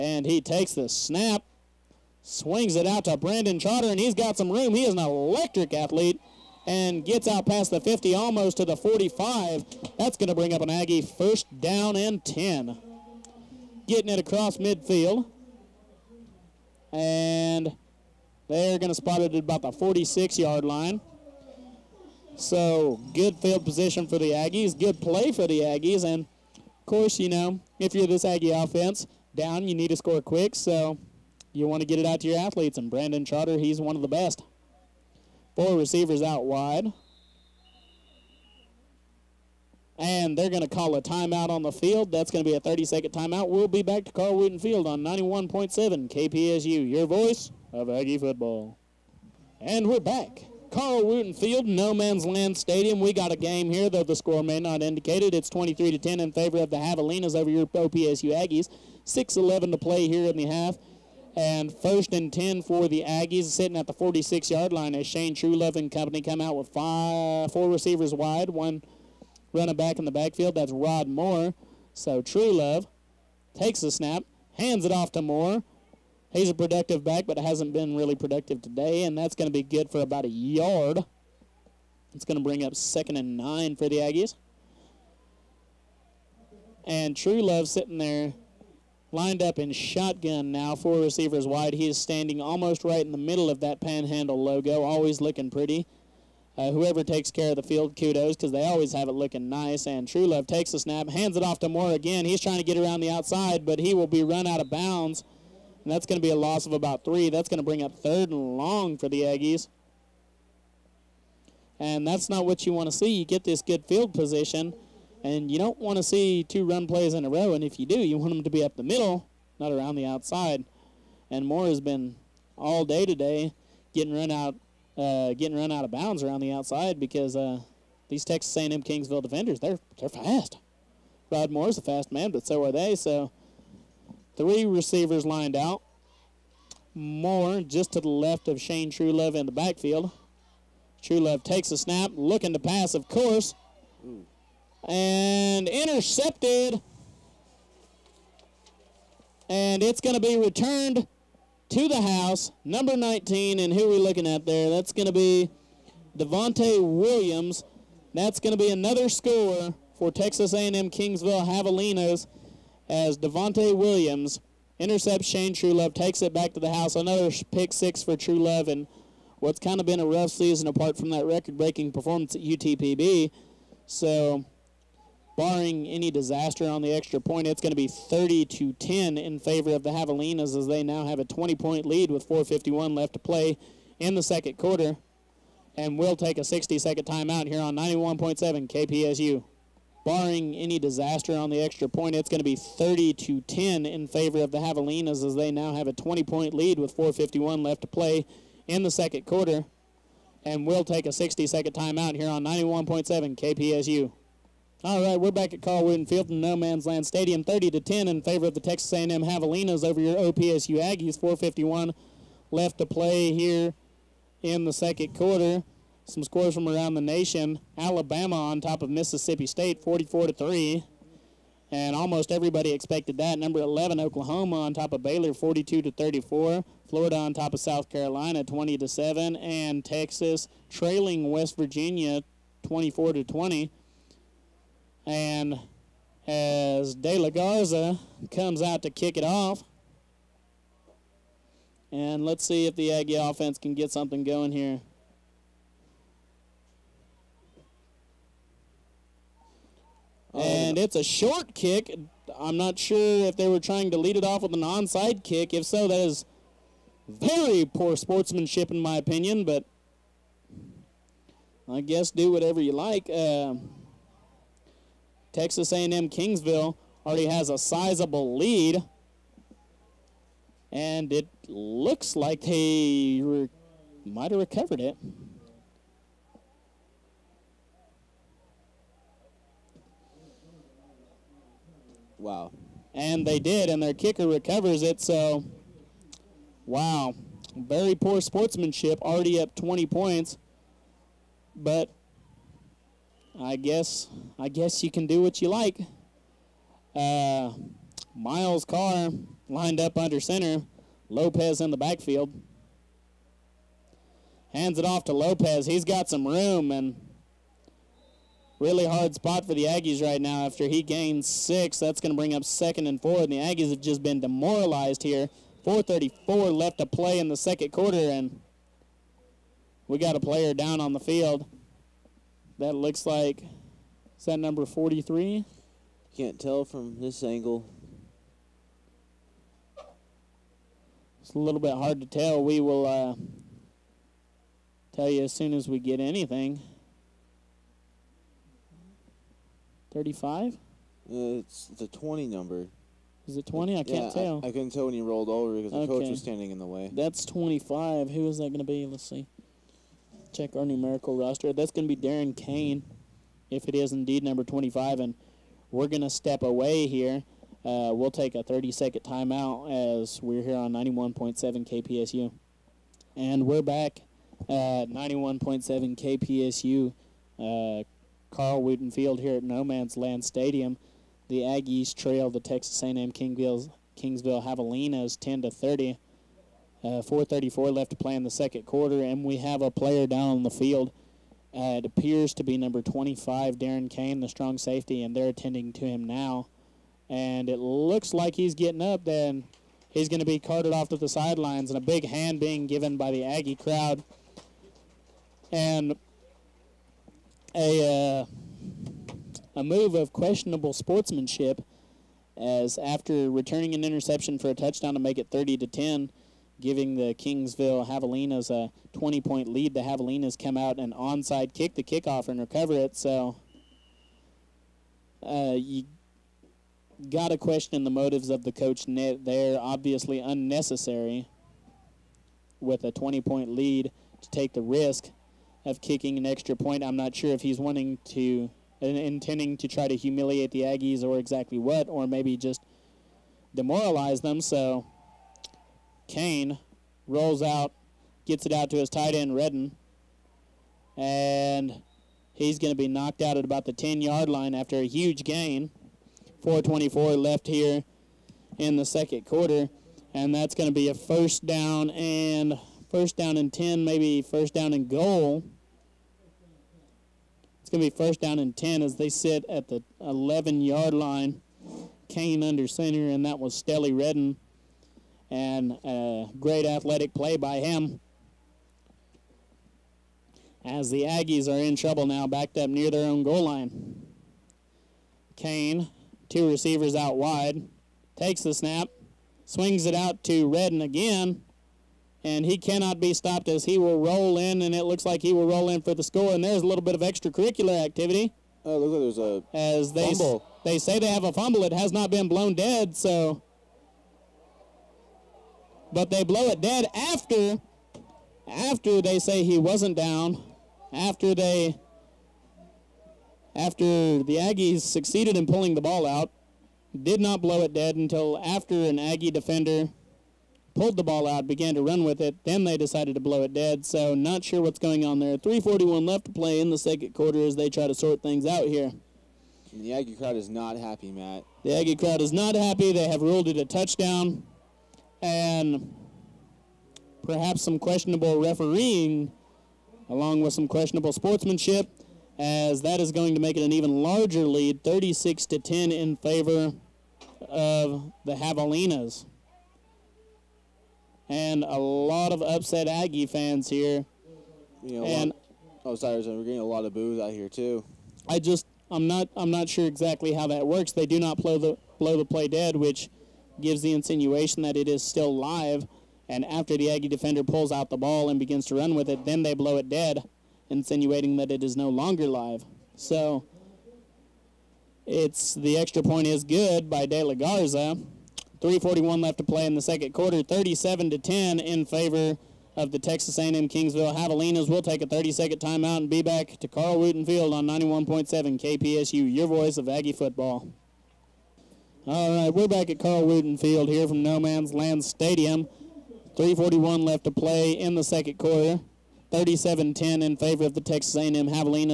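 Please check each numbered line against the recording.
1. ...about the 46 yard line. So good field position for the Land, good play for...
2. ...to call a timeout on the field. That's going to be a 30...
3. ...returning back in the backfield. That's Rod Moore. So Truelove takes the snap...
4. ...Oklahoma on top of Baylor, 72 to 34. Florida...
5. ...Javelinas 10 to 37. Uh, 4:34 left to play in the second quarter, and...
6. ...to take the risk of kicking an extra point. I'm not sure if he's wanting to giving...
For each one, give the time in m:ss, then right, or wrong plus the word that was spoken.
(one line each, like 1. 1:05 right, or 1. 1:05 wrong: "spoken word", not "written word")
1. 0:19 wrong: "Aggies", not "Land"
2. 0:40 right
3. 1:09 wrong: "running", not "returning"
4. 3:44 wrong: "42", not "72"
5. 6:14 wrong: "30", not "37"
6. 7:04 wrong: "intending", not "giving".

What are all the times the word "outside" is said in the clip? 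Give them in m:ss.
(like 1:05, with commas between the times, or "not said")
1:43, 2:00, 2:06.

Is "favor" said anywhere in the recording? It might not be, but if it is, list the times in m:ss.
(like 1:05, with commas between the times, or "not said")
0:56, 2:59, 3:14, 3:28, 8:56, 9:31, 9:50.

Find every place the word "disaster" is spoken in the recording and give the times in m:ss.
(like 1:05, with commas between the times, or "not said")
2:56, 3:10.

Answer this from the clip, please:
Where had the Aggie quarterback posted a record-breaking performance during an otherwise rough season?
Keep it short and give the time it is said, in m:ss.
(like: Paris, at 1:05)
UTPB, at 2:52.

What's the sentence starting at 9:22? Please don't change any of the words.
So it's the extra point is good by De La Garza.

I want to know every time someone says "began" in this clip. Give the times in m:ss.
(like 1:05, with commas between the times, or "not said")
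8:31.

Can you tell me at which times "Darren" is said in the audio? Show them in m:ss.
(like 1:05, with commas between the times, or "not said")
5:52, 6:23.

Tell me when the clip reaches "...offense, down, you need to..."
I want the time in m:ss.
0:28.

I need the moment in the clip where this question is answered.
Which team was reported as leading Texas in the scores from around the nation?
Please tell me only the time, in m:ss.
3:51.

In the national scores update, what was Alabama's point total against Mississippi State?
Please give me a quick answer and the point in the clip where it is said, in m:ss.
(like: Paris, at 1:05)
44, at 3:39.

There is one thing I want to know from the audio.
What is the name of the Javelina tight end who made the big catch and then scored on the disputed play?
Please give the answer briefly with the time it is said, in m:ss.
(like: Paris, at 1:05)
Stelly Redden, at 7:43.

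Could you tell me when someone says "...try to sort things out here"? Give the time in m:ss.
8:37.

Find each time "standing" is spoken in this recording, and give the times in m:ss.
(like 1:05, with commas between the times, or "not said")
1:31, 5:46.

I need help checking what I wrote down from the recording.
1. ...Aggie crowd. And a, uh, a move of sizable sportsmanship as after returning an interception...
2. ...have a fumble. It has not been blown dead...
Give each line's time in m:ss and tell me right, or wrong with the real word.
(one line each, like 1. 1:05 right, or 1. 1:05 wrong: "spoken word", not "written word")
1. 6:33 wrong: "questionable", not "sizable"
2. 8:11 right.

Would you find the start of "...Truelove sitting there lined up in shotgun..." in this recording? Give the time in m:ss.
1:27.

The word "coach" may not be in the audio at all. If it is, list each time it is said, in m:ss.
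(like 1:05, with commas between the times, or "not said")
5:45, 6:58.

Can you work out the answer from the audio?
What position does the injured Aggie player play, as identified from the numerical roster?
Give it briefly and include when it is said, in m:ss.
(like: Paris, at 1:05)
Strong safety, at 6:24.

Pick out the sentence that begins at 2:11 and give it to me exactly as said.
Rod Moore's a fast man, but so are they.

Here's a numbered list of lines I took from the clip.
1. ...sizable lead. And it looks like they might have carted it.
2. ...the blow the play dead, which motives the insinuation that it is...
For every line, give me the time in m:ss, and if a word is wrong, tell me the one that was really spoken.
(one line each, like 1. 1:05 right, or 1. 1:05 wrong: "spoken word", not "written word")
1. 4:27 wrong: "recovered", not "carted"
2. 9:11 wrong: "gives", not "motives".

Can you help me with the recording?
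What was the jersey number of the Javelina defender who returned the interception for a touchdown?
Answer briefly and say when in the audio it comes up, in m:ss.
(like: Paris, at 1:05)
19, at 2:32.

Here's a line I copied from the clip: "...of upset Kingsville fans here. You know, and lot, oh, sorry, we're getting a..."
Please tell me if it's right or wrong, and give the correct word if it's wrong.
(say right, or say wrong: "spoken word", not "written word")
wrong: "Aggie", not "Kingsville".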